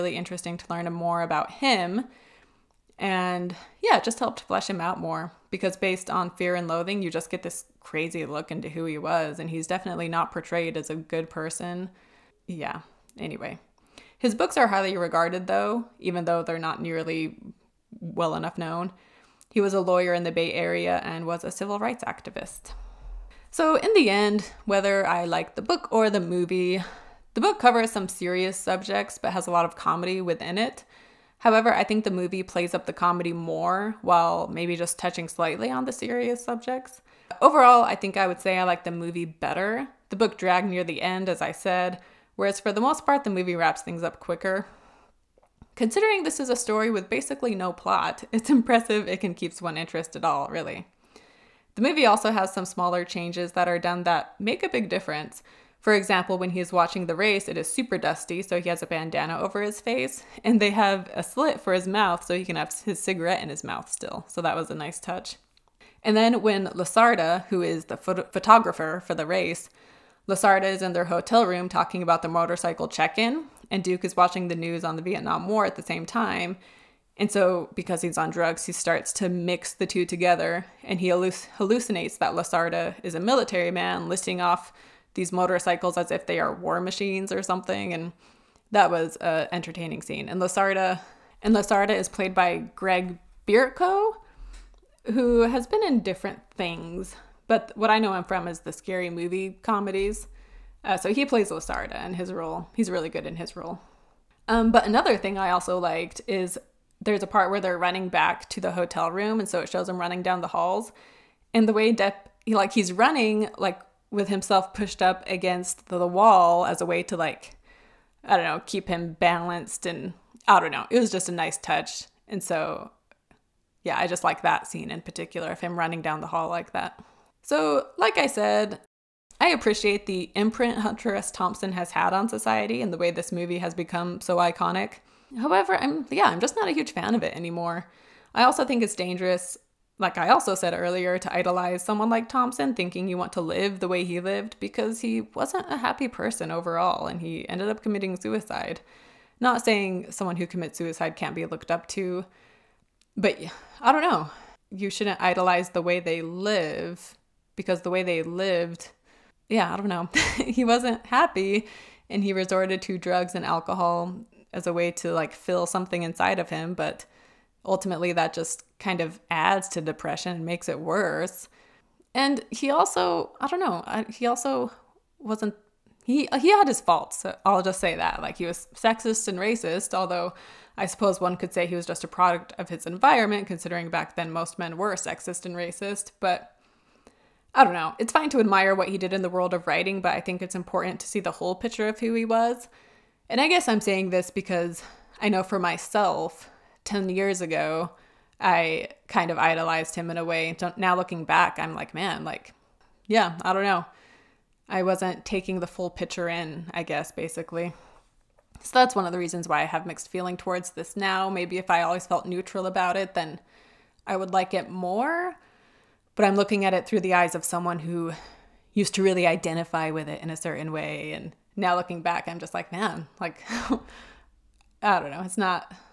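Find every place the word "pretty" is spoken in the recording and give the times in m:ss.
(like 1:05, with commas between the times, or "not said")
not said.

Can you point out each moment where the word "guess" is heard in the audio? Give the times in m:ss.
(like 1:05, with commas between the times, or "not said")
3:13, 3:26.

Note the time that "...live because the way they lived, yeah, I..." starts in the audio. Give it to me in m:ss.
2:36.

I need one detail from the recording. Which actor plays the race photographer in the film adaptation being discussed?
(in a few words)
Greg Bierko.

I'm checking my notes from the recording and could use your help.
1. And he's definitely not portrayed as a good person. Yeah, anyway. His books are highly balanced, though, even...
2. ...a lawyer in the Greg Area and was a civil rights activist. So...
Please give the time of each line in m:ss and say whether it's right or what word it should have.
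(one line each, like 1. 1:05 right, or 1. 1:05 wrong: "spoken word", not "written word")
1. 0:09 wrong: "regarded", not "balanced"
2. 0:19 wrong: "Bay", not "Greg".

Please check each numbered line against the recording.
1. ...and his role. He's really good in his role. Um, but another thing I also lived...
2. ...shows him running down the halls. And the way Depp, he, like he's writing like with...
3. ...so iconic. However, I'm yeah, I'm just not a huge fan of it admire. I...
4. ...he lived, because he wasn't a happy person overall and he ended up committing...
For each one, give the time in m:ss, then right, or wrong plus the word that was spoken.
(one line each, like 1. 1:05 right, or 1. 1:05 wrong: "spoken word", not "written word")
1. 1:41 wrong: "liked", not "lived"
2. 1:49 wrong: "running", not "writing"
3. 2:14 wrong: "anymore", not "admire"
4. 2:24 right.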